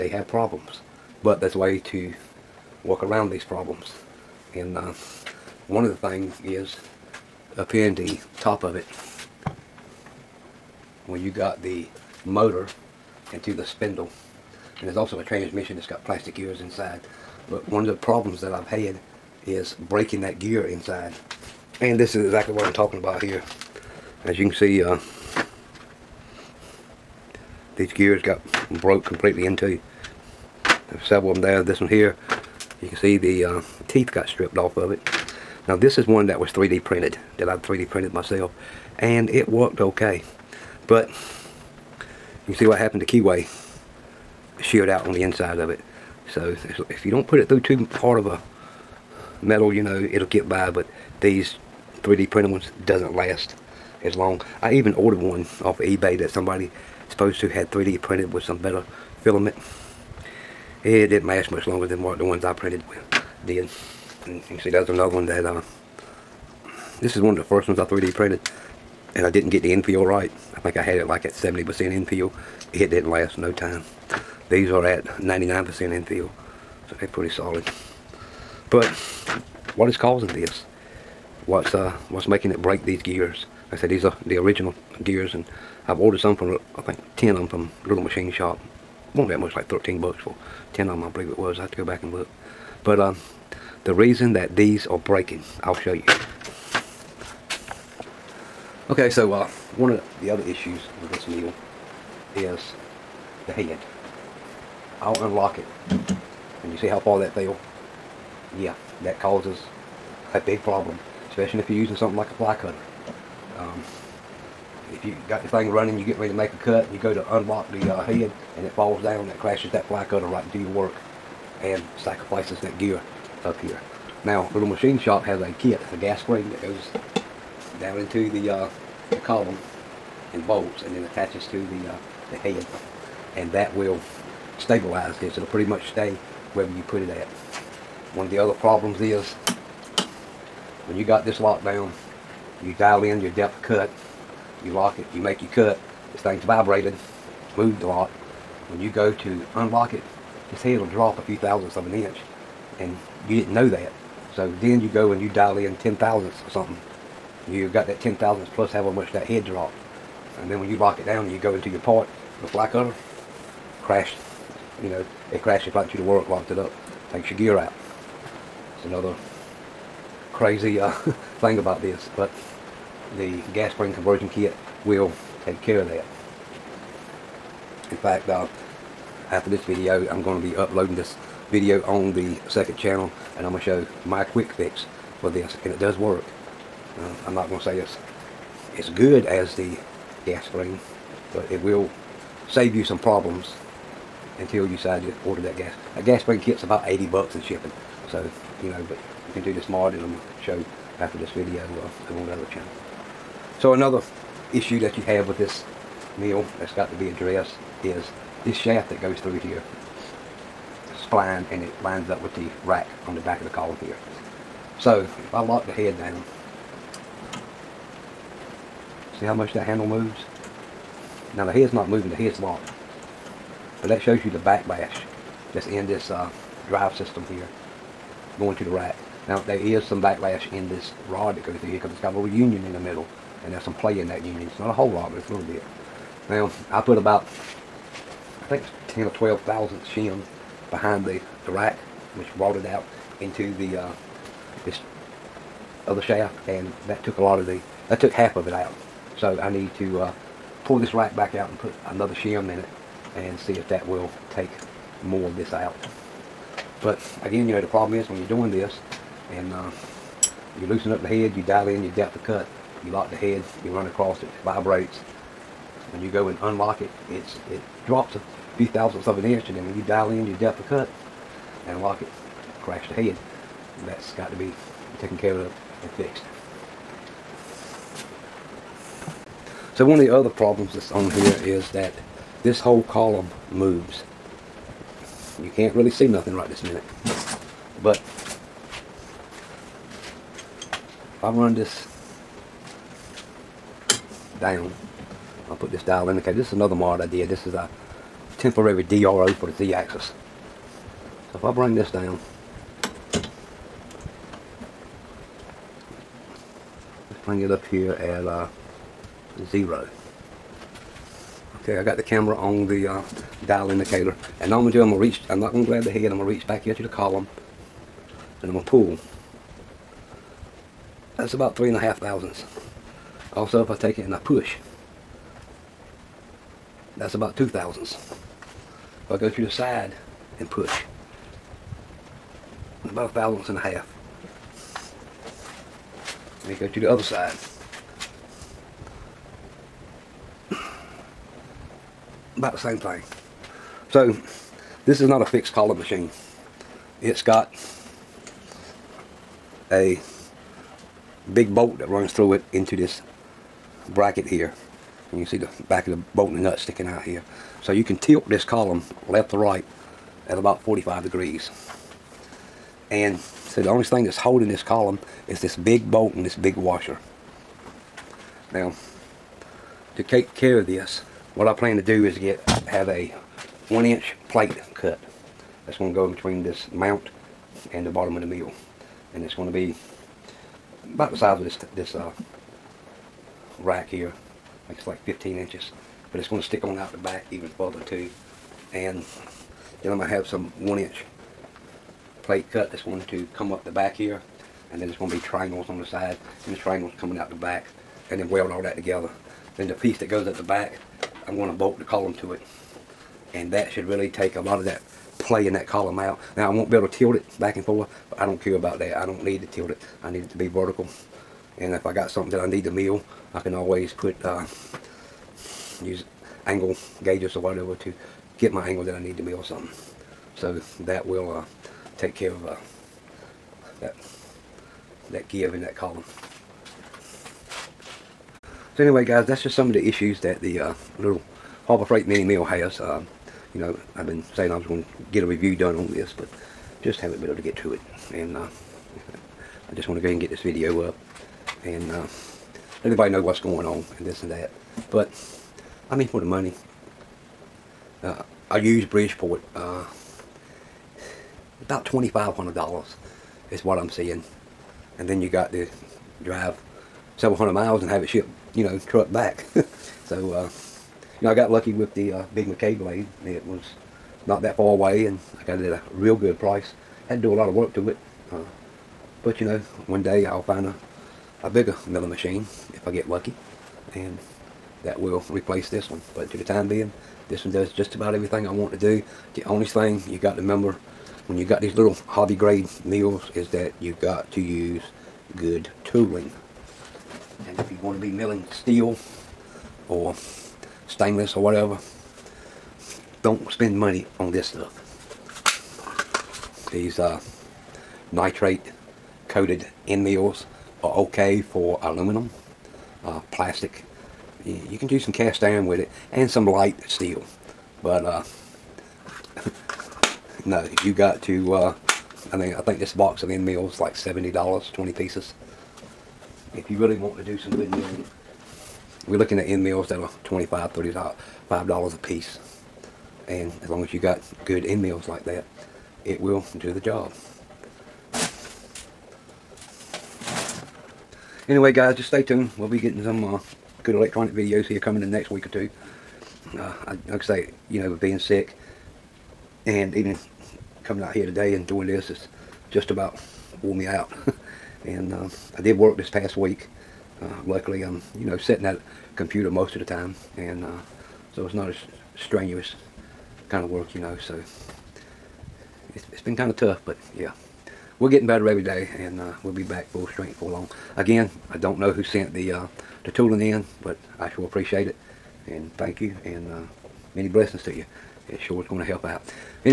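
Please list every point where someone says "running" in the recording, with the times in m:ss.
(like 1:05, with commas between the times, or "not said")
1:55.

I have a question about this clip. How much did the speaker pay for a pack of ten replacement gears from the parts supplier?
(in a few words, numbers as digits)
$13.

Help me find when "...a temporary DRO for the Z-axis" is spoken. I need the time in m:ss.
4:57.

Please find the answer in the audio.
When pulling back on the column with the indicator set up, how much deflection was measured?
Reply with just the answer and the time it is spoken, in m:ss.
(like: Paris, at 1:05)
3.5 thousandths, at 5:21.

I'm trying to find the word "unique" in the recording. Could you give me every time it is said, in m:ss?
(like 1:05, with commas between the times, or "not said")
not said.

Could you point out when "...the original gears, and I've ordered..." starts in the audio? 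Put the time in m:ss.
1:24.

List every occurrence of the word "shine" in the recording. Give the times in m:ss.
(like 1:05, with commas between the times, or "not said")
not said.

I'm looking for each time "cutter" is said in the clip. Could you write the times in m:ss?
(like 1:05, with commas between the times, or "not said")
1:52, 2:00, 2:42.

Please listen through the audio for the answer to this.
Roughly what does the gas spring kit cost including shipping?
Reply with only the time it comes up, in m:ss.
3:16.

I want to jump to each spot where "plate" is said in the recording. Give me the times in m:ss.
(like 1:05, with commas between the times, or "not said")
6:14, 6:32.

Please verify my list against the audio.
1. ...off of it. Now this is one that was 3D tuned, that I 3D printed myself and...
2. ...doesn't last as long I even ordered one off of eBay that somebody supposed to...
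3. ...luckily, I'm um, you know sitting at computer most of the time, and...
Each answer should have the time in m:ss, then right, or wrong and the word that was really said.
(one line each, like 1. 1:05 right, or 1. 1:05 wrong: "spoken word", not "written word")
1. 0:34 wrong: "printed", not "tuned"
2. 0:52 right
3. 9:07 right.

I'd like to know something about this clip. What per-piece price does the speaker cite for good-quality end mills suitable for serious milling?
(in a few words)
$25.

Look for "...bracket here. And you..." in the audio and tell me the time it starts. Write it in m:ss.
5:53.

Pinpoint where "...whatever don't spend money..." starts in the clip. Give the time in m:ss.
8:11.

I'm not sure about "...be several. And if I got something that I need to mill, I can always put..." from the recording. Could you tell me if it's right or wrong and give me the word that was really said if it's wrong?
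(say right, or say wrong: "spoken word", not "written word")
wrong: "vertical", not "several".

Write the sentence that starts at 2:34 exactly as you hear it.
So then you go and you dial in ten thousandths or something.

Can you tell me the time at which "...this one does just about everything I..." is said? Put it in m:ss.
7:57.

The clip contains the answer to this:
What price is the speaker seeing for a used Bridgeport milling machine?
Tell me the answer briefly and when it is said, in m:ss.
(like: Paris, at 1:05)
$2,500, at 7:31.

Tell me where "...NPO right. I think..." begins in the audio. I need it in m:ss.
1:09.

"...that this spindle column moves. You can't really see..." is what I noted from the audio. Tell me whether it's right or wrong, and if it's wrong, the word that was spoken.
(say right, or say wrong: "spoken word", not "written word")
wrong: "whole", not "spindle".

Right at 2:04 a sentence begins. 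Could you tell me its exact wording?
Now, Little Machine Shop has a kit.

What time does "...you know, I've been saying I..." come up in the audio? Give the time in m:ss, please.
7:13.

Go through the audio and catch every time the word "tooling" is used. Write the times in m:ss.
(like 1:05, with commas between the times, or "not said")
8:05, 9:23.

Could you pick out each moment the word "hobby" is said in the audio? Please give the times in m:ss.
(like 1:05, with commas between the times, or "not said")
8:02.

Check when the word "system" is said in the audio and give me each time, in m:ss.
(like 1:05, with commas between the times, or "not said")
3:46.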